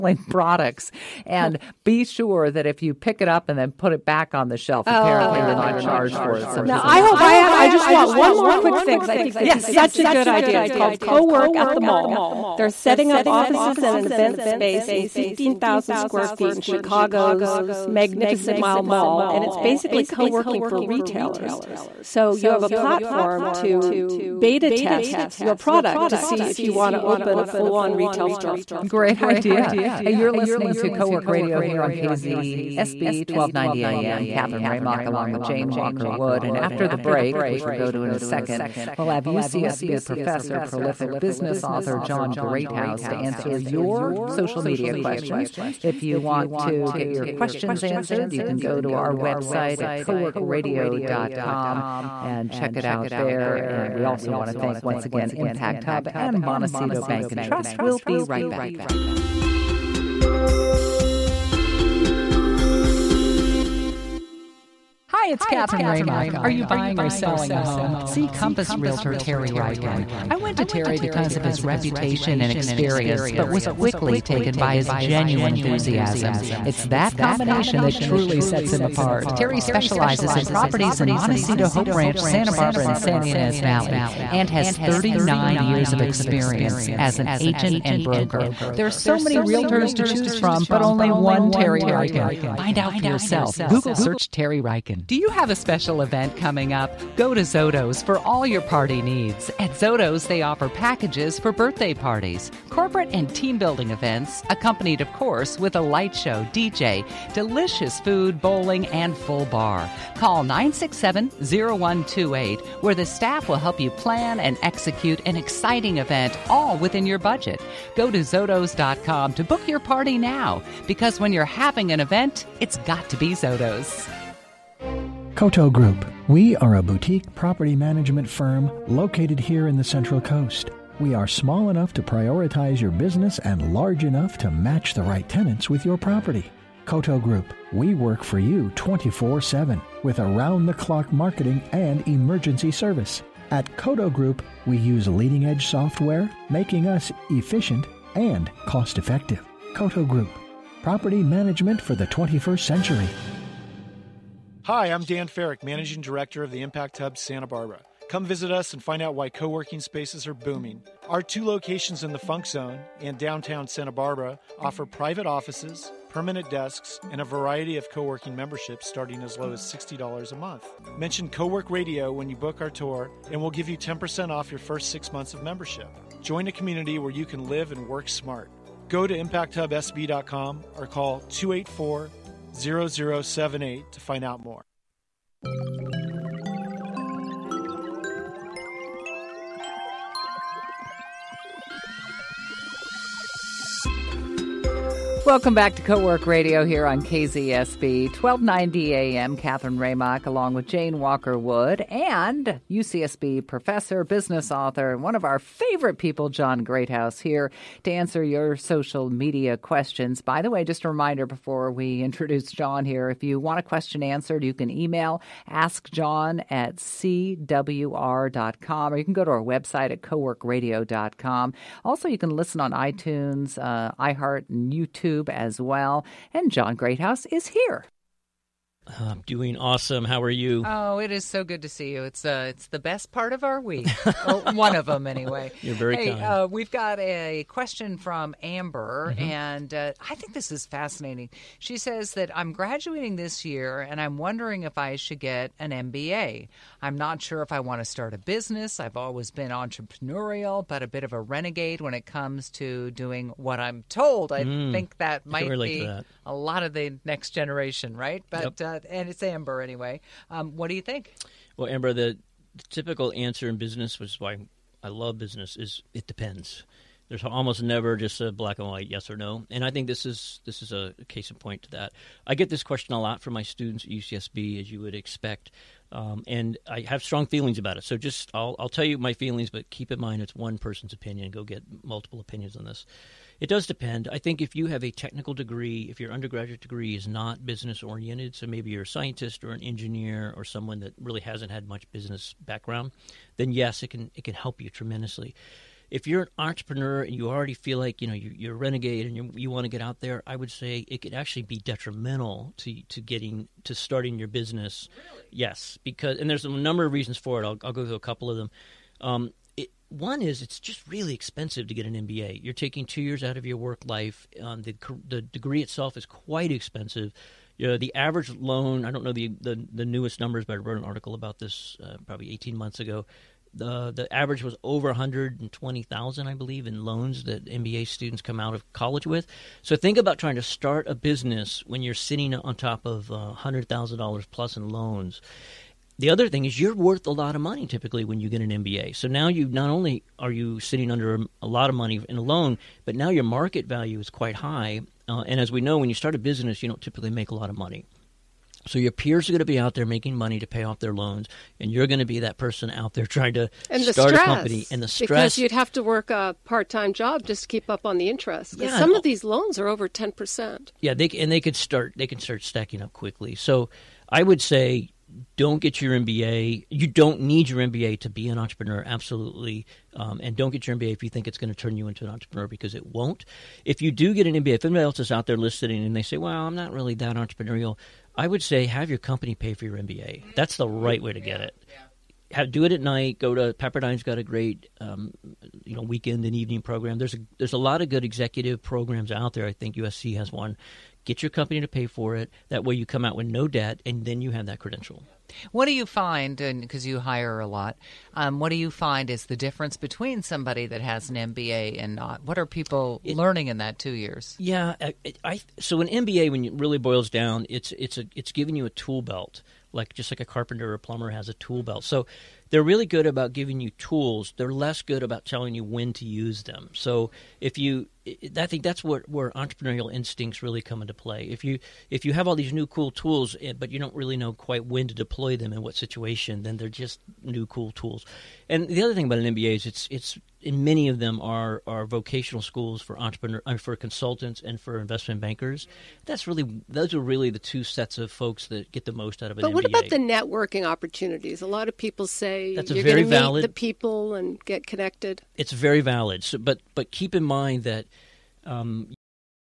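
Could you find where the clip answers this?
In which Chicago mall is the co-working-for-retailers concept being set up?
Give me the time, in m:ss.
0:17.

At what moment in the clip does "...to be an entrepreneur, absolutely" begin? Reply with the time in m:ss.
6:08.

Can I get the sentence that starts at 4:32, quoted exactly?
I get this question a lot from my students at UCSB, as you would expect.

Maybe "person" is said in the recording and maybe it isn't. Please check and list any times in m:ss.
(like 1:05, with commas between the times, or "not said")
4:40, 5:52.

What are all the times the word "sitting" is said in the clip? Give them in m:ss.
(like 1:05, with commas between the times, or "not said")
5:31, 5:40.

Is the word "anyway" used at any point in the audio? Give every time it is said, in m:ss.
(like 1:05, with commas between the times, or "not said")
3:55, 4:19.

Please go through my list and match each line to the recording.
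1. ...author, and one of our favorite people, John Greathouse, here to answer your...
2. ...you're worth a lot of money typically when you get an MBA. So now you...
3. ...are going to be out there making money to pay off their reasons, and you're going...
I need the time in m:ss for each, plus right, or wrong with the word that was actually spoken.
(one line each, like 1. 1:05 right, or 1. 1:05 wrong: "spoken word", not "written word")
1. 3:24 right
2. 5:36 right
3. 5:49 wrong: "loans", not "reasons".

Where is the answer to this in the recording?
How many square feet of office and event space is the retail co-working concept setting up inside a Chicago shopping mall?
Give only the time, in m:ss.
0:15.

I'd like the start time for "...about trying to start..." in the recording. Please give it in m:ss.
5:29.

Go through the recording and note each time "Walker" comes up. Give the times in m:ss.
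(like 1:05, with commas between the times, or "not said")
0:35, 3:20.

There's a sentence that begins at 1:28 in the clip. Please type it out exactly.
There are so many realtors to choose from, but only one Terry Ryken.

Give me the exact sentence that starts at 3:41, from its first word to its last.
Also, you can listen on iTunes, uh, iHeart, and YouTube YouTube as well.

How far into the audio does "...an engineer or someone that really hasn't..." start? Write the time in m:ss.
4:49.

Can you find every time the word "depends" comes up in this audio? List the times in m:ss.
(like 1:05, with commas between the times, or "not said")
4:26, 4:43.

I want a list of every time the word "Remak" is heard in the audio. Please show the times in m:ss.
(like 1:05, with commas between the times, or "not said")
0:34, 1:05, 3:19.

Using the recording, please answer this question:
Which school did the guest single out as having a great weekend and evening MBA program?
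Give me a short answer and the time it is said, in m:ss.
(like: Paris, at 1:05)
Pepperdine, at 6:23.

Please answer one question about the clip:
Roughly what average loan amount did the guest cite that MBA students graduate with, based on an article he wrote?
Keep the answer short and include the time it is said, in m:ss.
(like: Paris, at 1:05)
120,000, at 5:24.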